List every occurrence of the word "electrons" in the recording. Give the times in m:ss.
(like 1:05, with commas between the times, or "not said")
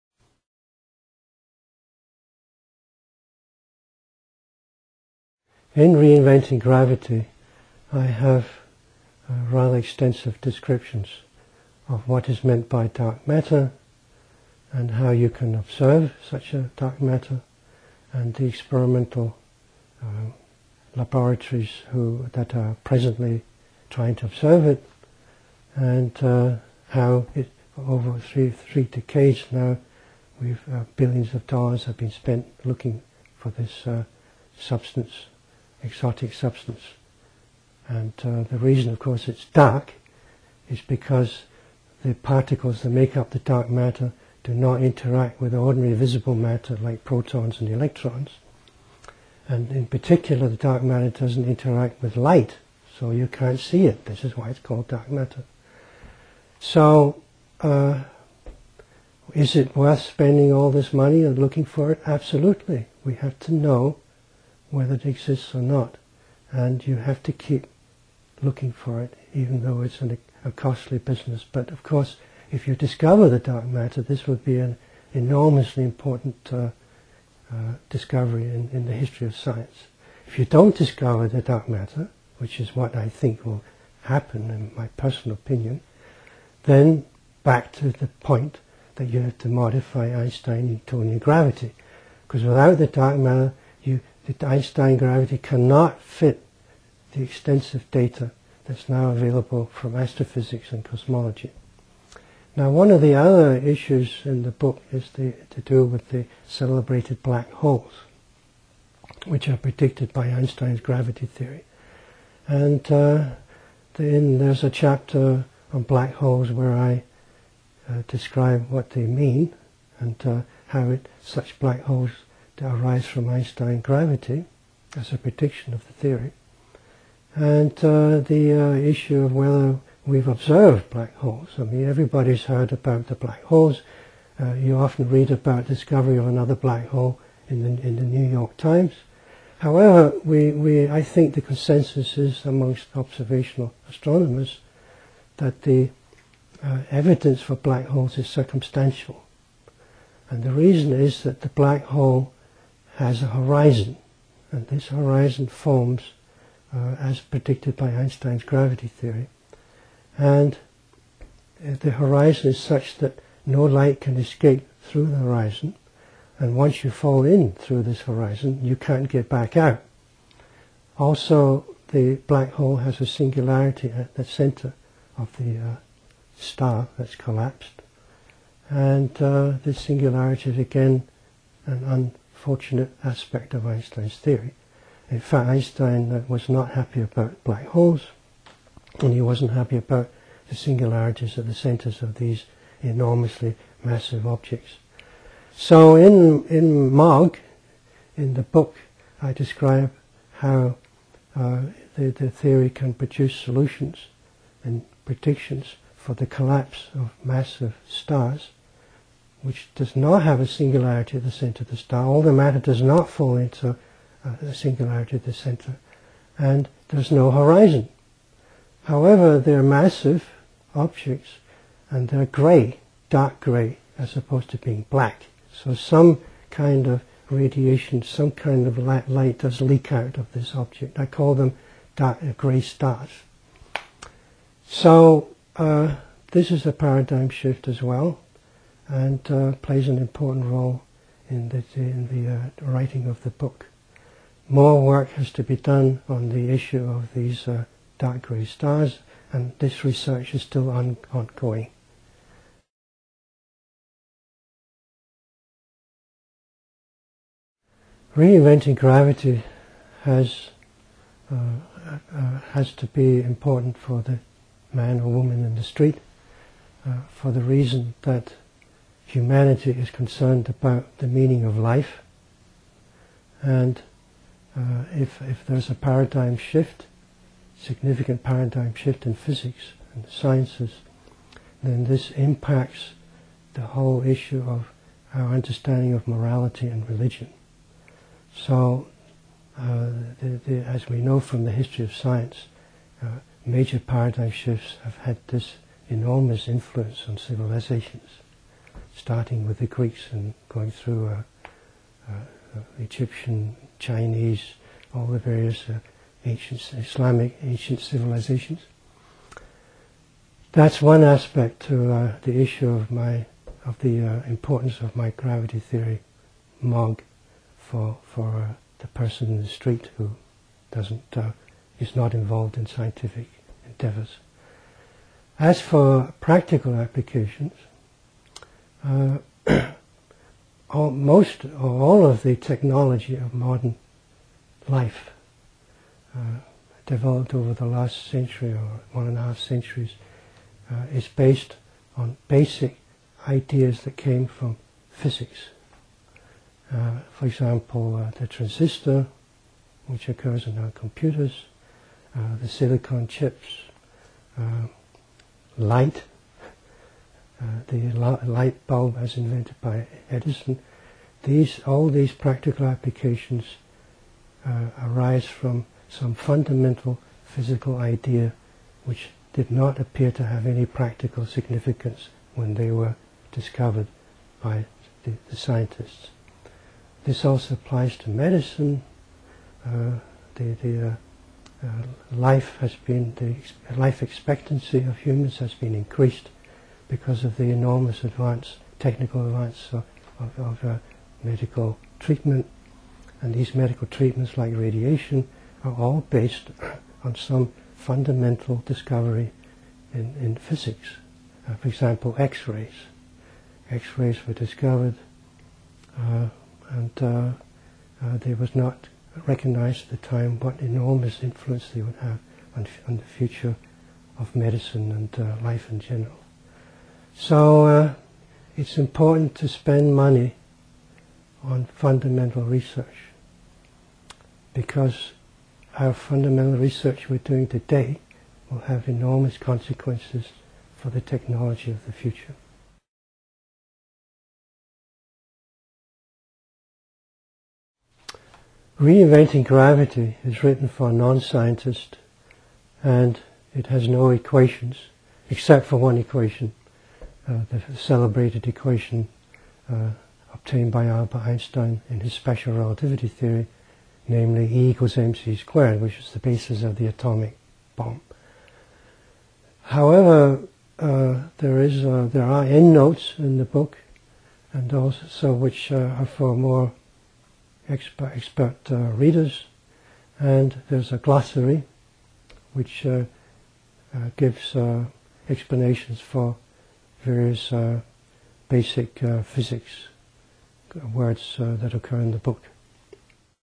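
0:47.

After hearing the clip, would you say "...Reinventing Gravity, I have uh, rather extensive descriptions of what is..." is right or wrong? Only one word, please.
right.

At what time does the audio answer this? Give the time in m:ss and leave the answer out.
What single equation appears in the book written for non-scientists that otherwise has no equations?
7:34.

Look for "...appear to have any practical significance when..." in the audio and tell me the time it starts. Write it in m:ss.
6:09.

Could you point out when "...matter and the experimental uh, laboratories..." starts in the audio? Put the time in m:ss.
0:17.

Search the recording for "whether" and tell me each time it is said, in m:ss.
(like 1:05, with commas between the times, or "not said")
1:04, 2:09.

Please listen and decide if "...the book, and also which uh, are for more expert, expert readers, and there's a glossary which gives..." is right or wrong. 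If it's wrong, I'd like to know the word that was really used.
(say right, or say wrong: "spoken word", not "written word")
right.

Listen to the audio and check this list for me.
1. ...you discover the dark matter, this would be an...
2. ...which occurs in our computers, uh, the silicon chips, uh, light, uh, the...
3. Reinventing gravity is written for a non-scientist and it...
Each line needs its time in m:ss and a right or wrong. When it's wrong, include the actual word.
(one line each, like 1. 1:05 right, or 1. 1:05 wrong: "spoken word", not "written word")
1. 1:12 right
2. 5:49 right
3. 7:18 right.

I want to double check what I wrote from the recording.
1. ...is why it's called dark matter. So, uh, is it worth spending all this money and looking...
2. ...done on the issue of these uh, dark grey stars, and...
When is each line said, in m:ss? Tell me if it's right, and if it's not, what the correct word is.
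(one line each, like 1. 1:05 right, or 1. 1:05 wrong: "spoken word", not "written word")
1. 0:54 right
2. 4:05 right.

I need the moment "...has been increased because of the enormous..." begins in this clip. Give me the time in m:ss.
6:25.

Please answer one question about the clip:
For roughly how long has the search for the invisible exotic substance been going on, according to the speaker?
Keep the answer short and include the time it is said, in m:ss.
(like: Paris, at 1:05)
3 decades, at 0:28.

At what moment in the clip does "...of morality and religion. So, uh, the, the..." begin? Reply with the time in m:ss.
4:45.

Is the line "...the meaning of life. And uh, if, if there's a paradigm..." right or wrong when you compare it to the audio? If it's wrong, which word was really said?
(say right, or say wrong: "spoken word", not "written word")
right.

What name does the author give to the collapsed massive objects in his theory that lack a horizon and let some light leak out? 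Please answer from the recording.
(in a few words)
dark grey stars.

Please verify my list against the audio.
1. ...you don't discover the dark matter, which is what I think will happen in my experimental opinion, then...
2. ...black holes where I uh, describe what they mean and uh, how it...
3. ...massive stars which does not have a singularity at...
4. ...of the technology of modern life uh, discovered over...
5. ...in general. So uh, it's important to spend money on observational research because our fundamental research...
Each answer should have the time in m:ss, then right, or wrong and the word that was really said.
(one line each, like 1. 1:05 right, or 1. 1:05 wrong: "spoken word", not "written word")
1. 1:20 wrong: "personal", not "experimental"
2. 1:55 right
3. 3:27 right
4. 5:32 wrong: "developed", not "discovered"
5. 6:55 wrong: "fundamental", not "observational".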